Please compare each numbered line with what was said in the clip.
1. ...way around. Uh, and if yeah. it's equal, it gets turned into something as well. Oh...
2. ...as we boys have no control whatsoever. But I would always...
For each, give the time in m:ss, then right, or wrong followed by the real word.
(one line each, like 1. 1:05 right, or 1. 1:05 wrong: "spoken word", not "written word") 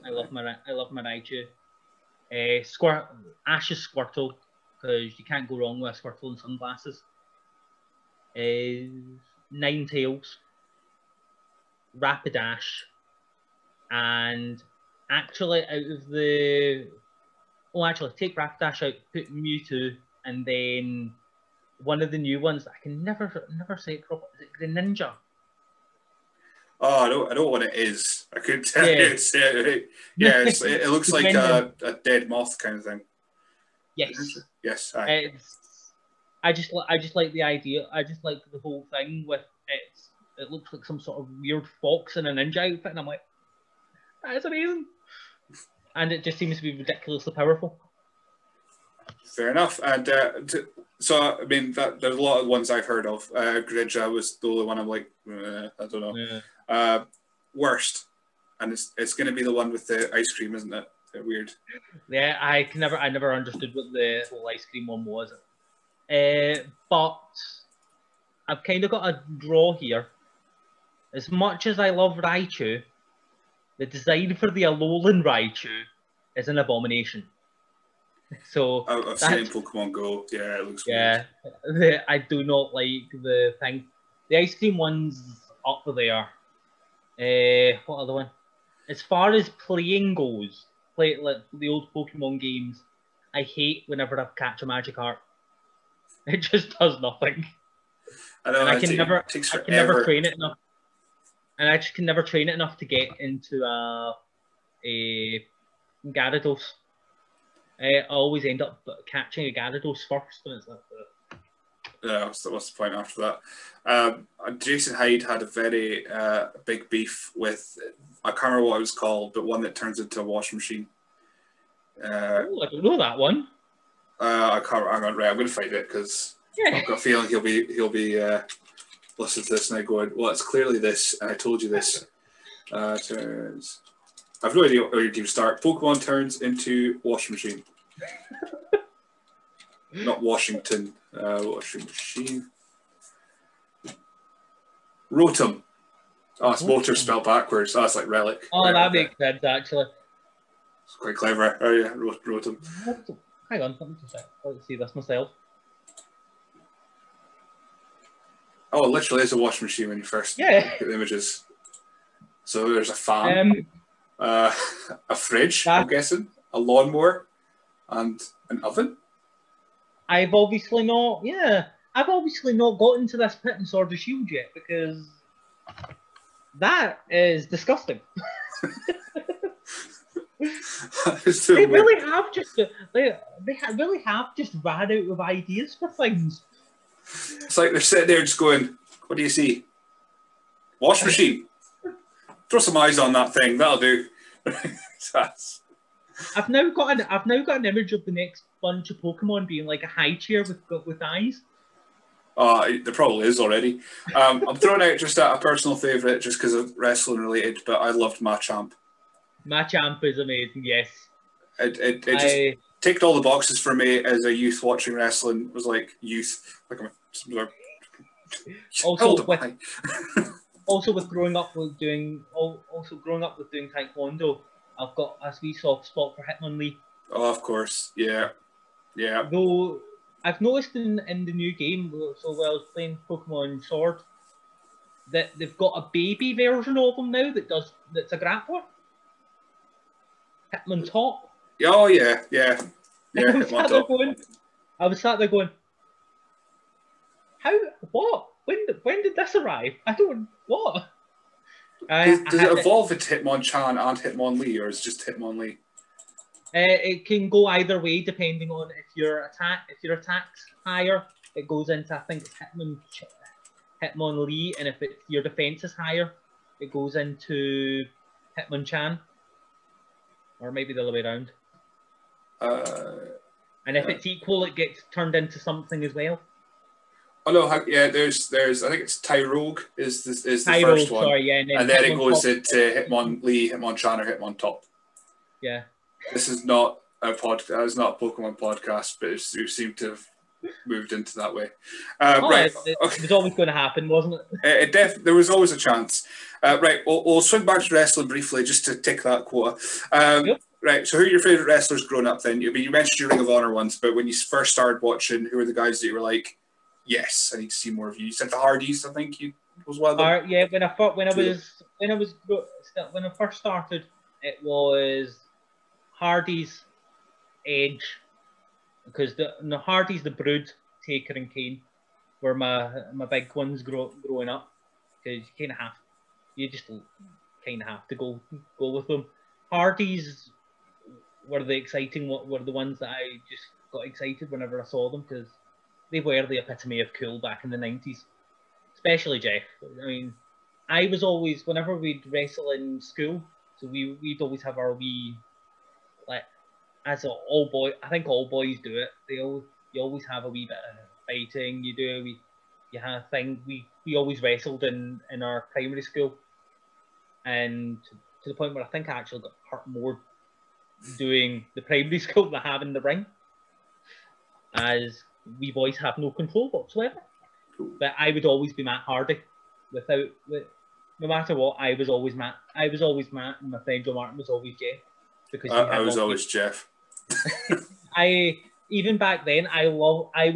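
1. 4:30 right
2. 6:04 right.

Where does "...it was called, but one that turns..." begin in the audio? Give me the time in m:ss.
1:58.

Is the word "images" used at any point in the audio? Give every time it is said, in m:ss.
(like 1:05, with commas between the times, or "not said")
2:40, 3:17.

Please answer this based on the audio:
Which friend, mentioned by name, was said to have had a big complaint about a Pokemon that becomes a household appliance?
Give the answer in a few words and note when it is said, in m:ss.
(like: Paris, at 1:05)
Jason Hyde, at 1:54.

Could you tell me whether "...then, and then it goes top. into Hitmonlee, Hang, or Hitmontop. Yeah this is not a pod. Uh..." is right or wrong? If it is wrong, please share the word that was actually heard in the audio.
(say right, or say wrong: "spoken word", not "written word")
wrong: "Hitmonchan", not "Hang".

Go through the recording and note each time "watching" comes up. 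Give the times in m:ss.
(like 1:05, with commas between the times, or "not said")
3:34, 5:04.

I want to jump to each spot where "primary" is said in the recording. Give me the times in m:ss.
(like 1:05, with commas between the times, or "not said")
5:55, 6:01.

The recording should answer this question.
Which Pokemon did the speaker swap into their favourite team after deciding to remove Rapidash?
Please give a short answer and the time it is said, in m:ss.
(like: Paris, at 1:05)
Mewtwo, at 0:19.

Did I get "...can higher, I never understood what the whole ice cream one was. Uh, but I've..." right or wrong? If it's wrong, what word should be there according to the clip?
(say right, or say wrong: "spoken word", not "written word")
wrong: "never", not "higher".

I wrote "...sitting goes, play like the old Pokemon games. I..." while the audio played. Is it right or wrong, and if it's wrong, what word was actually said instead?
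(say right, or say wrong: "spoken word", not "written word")
wrong: "playing", not "sitting".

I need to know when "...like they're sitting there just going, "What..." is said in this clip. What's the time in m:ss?
3:07.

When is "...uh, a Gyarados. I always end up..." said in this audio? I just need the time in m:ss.
1:44.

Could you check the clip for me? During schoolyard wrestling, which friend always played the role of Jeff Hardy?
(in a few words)
Joe Martin.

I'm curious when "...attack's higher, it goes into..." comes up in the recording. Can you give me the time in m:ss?
4:19.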